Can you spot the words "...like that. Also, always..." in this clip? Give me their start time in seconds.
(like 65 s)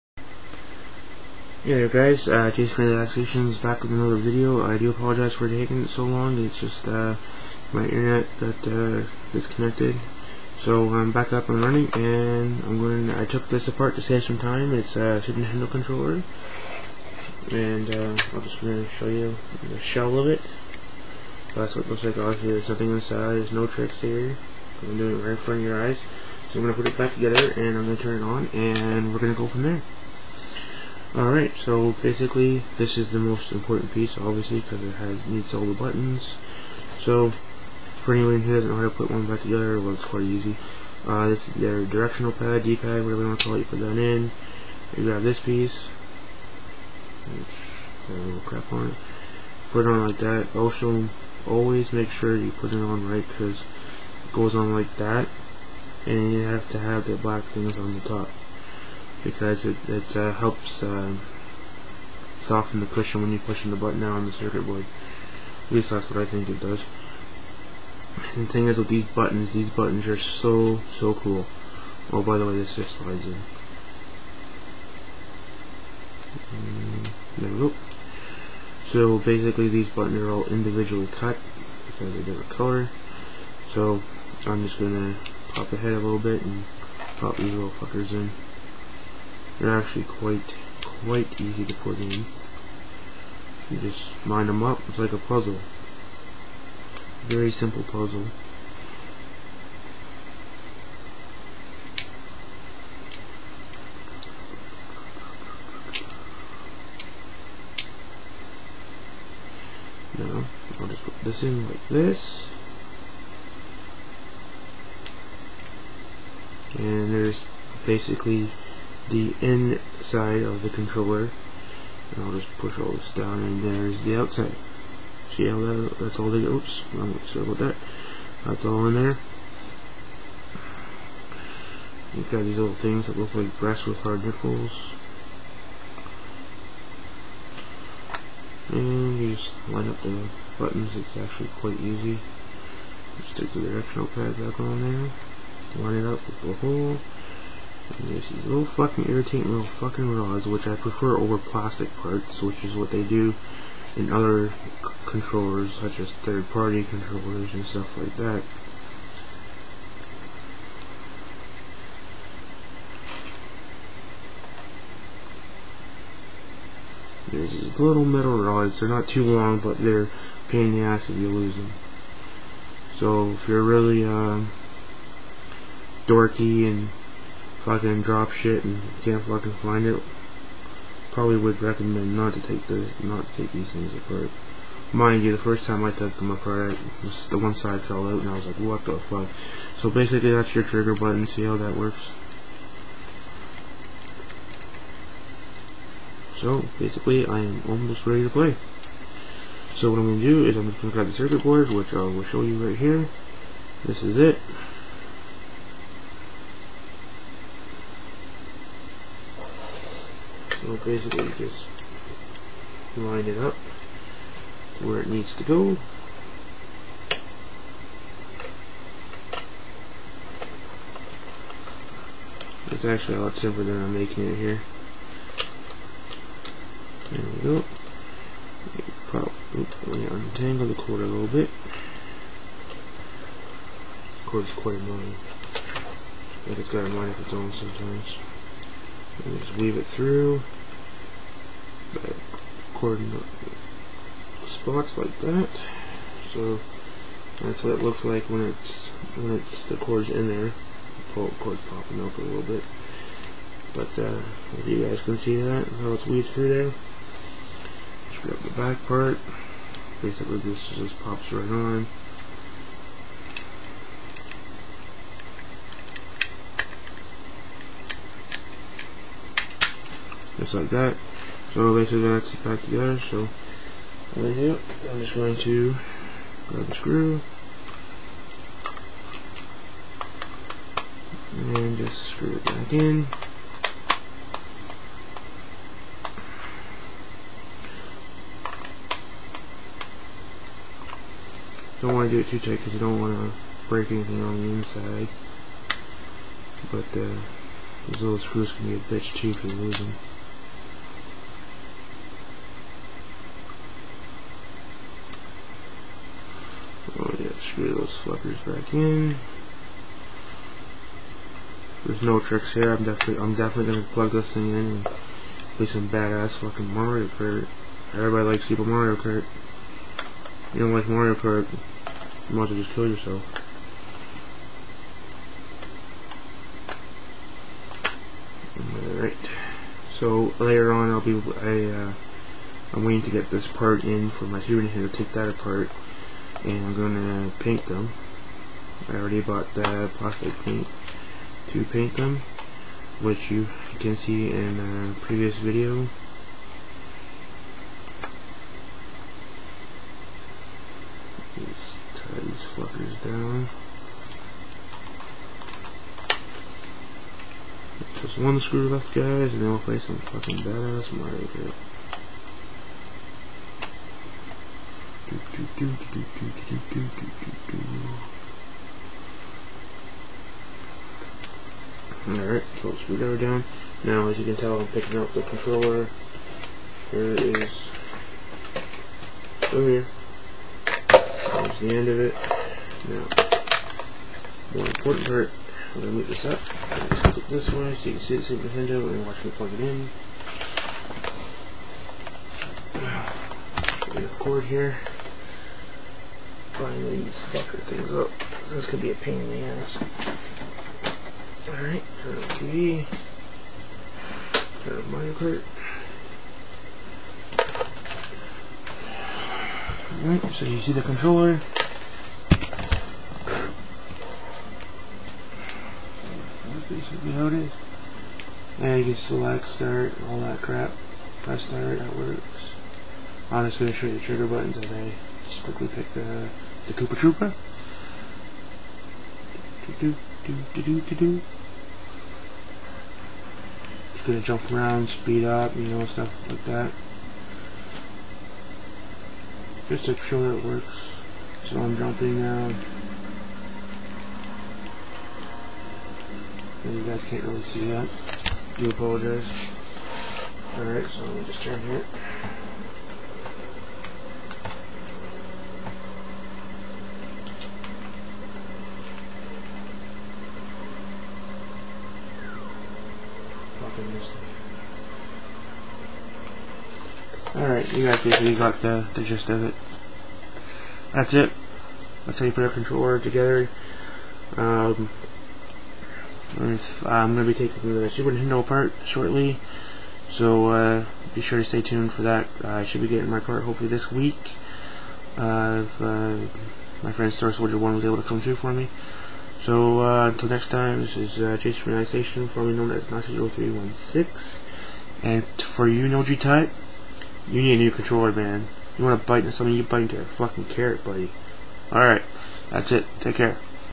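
50 s.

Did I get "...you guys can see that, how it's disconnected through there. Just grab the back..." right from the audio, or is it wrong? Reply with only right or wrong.
wrong.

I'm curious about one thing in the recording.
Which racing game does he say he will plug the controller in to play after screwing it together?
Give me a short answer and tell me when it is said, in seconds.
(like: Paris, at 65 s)
Super Mario Kart, at 318 s.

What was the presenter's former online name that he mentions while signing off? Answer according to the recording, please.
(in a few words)
Nazi0316.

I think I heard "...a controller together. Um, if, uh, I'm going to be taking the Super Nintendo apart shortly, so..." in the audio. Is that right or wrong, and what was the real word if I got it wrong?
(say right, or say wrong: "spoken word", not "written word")
right.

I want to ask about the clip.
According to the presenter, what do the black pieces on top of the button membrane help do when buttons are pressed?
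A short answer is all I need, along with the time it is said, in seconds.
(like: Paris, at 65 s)
soften the cushion, at 62 s.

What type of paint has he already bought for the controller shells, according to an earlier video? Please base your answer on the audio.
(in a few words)
plastic paint.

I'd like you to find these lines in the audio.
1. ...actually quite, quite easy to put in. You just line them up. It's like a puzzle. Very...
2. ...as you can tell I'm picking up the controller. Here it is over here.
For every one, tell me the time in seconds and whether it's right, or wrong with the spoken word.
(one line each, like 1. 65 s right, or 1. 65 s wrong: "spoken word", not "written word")
1. 89 s right
2. 374 s right.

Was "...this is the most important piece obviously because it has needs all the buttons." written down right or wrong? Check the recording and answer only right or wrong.
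right.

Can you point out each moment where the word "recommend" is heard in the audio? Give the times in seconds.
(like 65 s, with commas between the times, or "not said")
181 s.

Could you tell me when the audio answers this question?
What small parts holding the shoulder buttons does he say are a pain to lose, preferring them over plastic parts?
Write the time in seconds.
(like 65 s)
168 s.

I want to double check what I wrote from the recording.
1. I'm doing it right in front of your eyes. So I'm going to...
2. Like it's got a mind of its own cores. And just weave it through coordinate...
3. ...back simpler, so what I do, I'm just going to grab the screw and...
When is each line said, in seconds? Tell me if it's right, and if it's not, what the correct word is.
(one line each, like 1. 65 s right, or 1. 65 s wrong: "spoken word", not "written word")
1. 24 s right
2. 236 s wrong: "sometimes", not "cores"
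3. 272 s wrong: "together", not "simpler".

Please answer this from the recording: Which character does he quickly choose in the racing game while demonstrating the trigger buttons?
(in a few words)
Koopa Troopa.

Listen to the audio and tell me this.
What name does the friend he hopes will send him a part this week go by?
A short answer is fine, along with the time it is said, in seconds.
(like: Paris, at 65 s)
Star Soldier 1, at 487 s.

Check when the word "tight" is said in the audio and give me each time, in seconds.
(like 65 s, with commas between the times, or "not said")
292 s.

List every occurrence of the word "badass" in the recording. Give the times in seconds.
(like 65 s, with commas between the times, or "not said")
315 s, 360 s.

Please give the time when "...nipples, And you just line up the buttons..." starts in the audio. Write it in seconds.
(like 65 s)
134 s.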